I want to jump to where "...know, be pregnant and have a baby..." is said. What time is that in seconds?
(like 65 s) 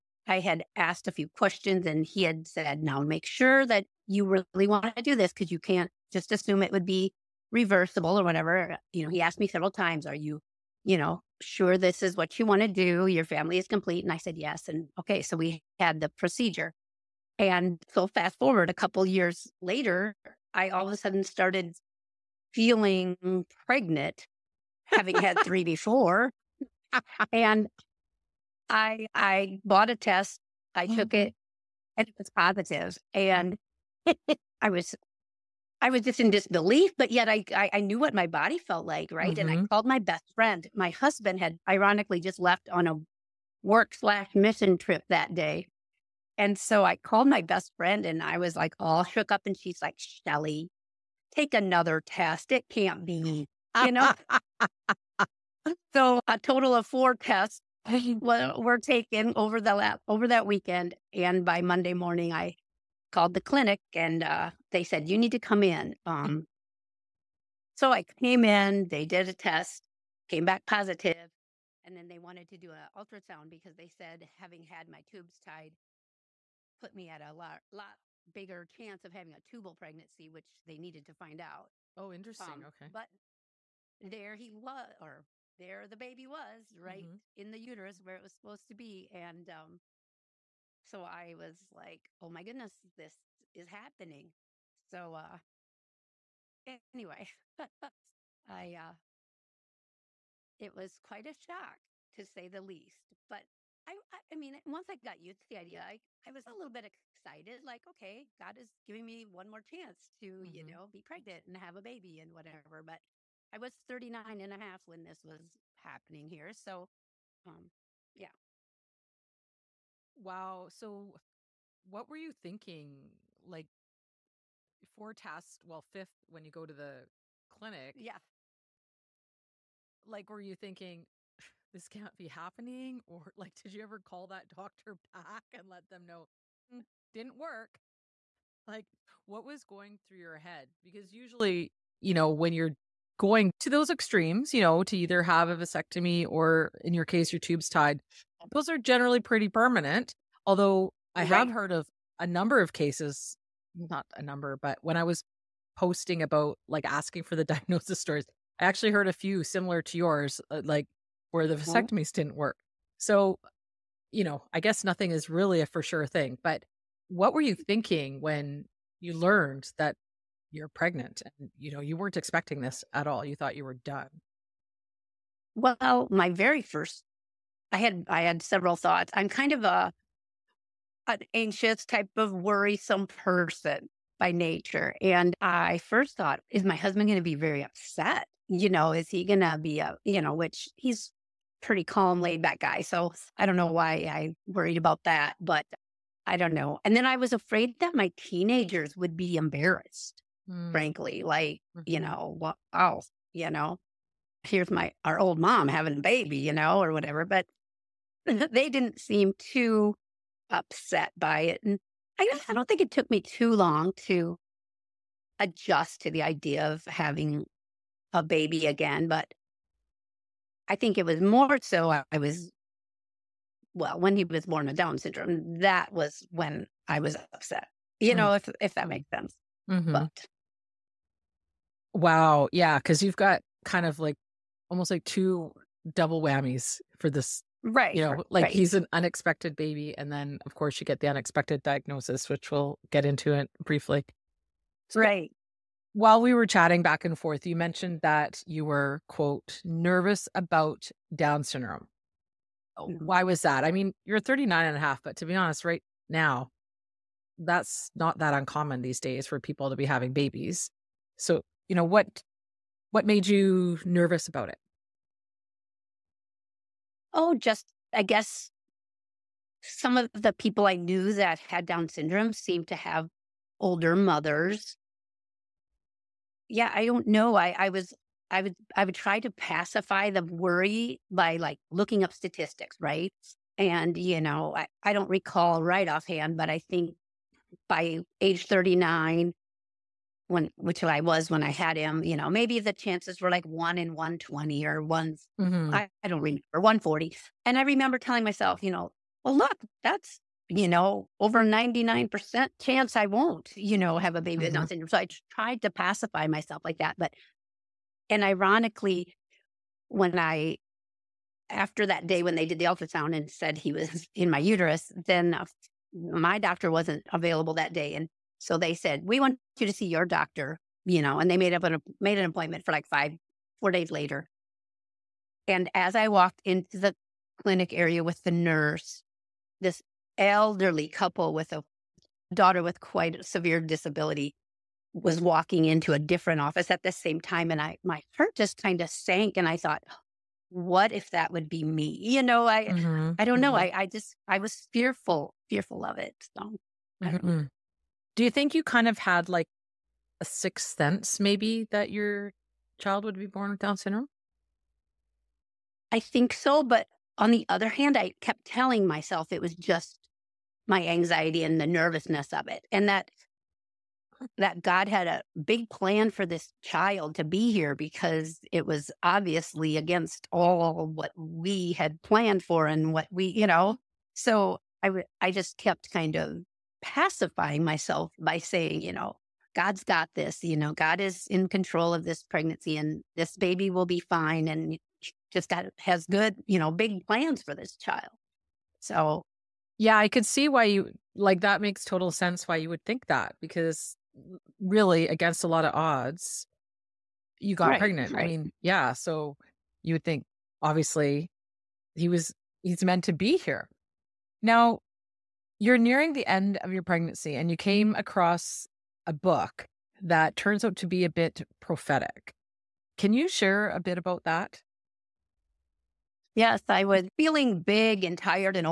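110 s.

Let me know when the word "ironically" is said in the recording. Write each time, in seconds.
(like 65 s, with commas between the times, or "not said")
41 s, 308 s.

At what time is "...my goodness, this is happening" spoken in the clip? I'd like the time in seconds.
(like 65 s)
92 s.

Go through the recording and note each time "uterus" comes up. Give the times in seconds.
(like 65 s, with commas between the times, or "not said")
87 s, 314 s.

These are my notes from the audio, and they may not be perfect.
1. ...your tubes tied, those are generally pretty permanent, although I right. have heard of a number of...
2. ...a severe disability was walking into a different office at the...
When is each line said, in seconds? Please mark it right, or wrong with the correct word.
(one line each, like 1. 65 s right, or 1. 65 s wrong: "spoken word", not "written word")
1. 147 s right
2. 333 s right.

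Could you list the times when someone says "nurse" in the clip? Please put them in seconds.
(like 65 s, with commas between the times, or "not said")
328 s.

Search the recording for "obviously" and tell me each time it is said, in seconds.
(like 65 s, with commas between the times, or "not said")
369 s, 400 s.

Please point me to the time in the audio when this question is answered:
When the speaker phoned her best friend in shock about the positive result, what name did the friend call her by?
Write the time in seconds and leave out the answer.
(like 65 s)
49 s.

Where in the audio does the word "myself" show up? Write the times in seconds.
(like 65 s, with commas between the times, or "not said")
298 s, 306 s, 358 s, 377 s.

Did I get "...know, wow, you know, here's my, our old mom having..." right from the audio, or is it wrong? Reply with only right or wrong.
right.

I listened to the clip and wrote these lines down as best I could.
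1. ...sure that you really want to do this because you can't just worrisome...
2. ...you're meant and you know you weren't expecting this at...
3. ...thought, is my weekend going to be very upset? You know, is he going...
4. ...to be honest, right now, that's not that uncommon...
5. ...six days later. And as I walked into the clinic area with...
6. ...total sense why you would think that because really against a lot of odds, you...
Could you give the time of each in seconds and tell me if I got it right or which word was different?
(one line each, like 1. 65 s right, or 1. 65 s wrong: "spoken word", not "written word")
1. 3 s wrong: "assume", not "worrisome"
2. 170 s wrong: "pregnant", not "meant"
3. 186 s wrong: "husband", not "weekend"
4. 255 s right
5. 323 s wrong: "four", not "six"
6. 391 s right.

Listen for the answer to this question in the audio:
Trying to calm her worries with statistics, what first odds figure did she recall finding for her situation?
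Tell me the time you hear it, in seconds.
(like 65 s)
293 s.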